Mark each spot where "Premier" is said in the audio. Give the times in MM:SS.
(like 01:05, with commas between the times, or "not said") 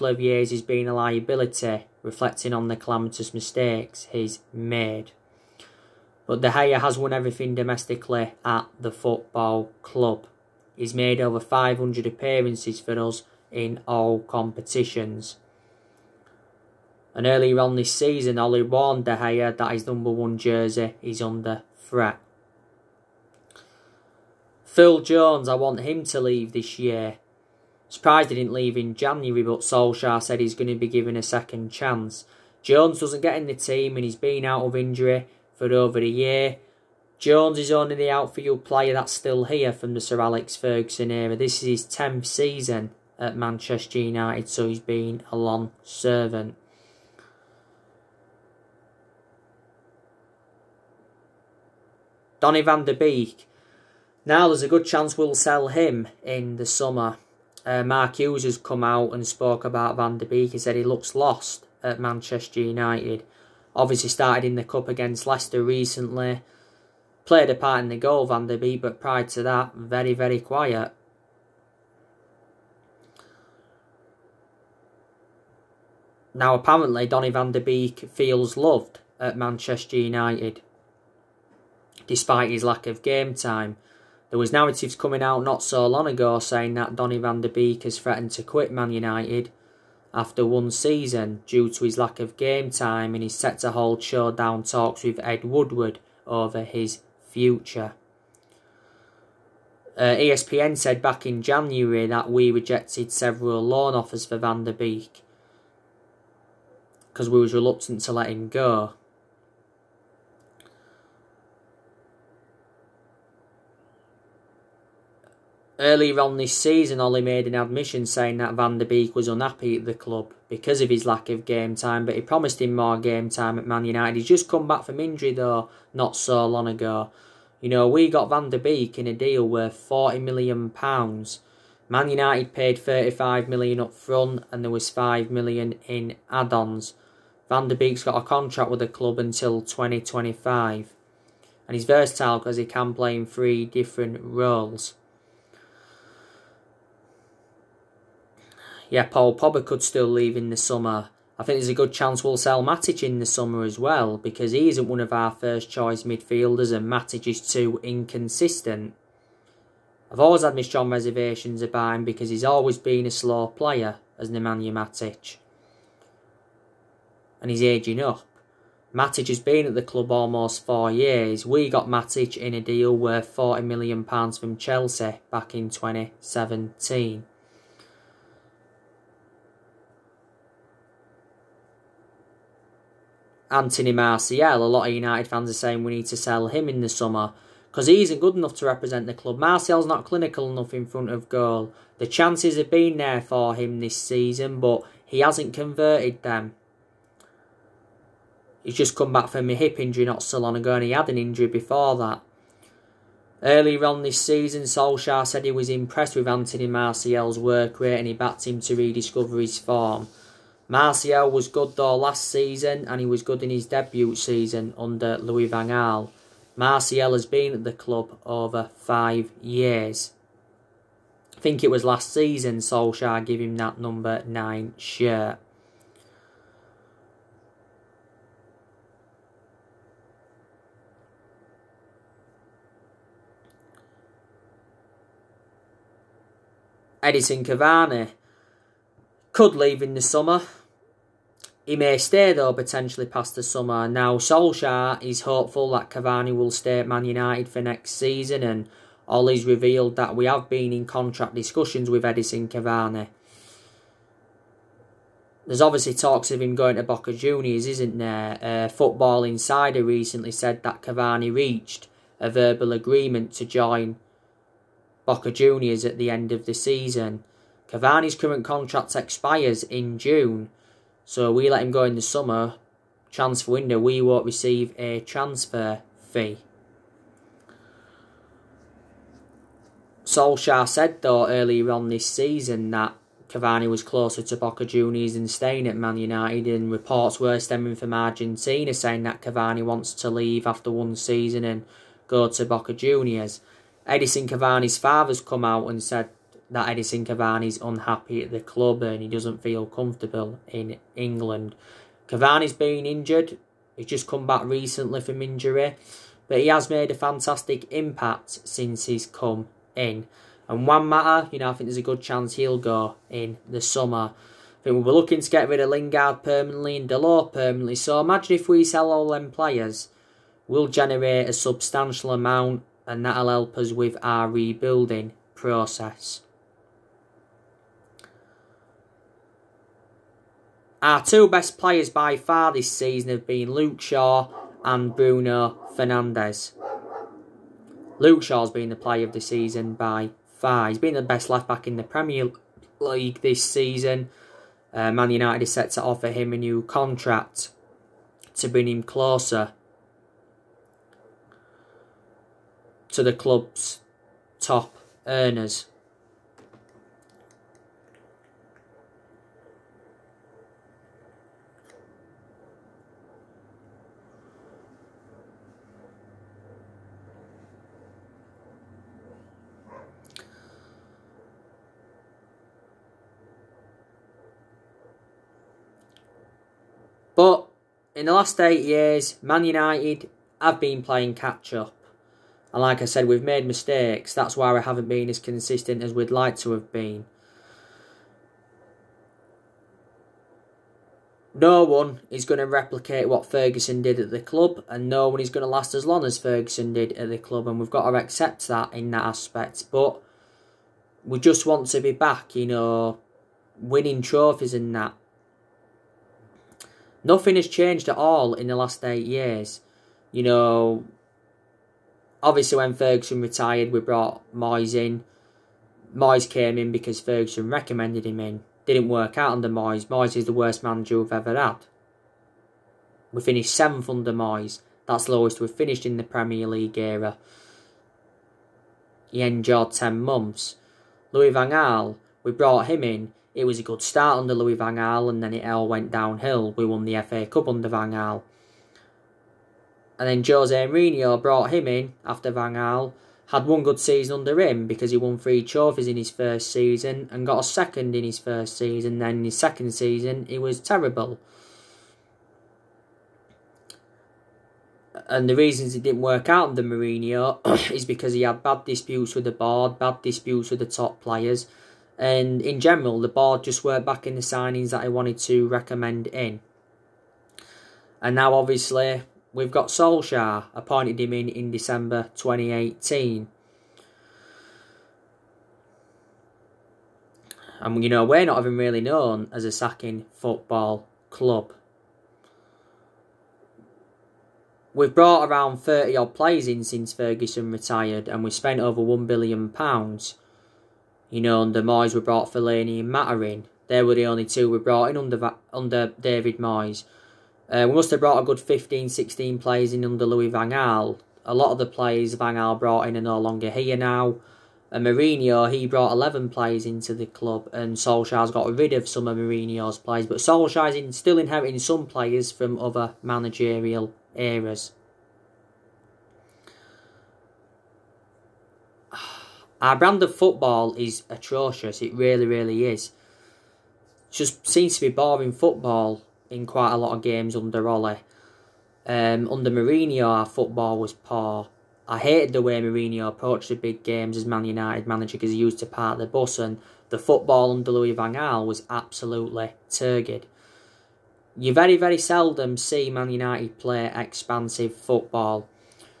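05:41, 07:06.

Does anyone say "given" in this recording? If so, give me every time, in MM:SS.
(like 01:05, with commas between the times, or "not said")
00:30.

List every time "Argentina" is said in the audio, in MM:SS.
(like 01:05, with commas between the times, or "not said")
04:47.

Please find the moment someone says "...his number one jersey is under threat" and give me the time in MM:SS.
00:19.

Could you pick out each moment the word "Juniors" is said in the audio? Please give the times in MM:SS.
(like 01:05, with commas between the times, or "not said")
04:17, 04:25, 04:44, 04:52.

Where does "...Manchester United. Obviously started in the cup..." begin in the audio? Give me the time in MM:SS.
01:01.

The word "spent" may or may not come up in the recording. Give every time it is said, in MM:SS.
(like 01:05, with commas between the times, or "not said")
08:08.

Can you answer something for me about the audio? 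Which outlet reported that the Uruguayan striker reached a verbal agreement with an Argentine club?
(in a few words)
Football Insider.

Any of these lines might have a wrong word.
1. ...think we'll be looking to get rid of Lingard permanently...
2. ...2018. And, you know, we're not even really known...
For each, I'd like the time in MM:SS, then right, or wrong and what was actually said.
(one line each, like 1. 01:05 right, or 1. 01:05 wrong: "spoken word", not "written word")
1. 05:14 right
2. 07:52 right.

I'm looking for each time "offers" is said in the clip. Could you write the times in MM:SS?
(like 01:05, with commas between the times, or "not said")
01:43, 05:45.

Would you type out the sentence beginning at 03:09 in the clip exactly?
Martial's not clinical enough in front of goal.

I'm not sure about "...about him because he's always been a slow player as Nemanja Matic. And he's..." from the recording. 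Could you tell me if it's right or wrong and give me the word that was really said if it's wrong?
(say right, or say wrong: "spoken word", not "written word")
right.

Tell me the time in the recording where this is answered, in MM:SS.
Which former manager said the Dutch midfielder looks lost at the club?
00:57.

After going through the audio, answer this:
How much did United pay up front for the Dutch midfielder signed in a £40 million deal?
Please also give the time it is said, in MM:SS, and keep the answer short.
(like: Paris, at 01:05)
£35 million, at 02:12.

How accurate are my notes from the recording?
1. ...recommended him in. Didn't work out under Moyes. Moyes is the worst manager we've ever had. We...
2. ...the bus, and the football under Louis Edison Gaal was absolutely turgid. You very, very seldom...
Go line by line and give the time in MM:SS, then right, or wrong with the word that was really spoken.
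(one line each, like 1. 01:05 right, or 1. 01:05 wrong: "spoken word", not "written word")
1. 06:57 right
2. 08:55 wrong: "Van", not "Edison".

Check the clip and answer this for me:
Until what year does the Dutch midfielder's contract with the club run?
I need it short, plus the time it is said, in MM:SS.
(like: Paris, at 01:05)
2025, at 02:19.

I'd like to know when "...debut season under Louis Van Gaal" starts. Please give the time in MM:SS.
03:33.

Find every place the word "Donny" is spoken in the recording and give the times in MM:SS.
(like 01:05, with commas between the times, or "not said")
00:52, 01:17, 01:26.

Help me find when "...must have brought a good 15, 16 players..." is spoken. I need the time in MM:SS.
08:17.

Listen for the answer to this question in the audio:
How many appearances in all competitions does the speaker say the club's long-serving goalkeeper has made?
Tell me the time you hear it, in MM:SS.
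00:11.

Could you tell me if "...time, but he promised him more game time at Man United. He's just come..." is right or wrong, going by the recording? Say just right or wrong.
right.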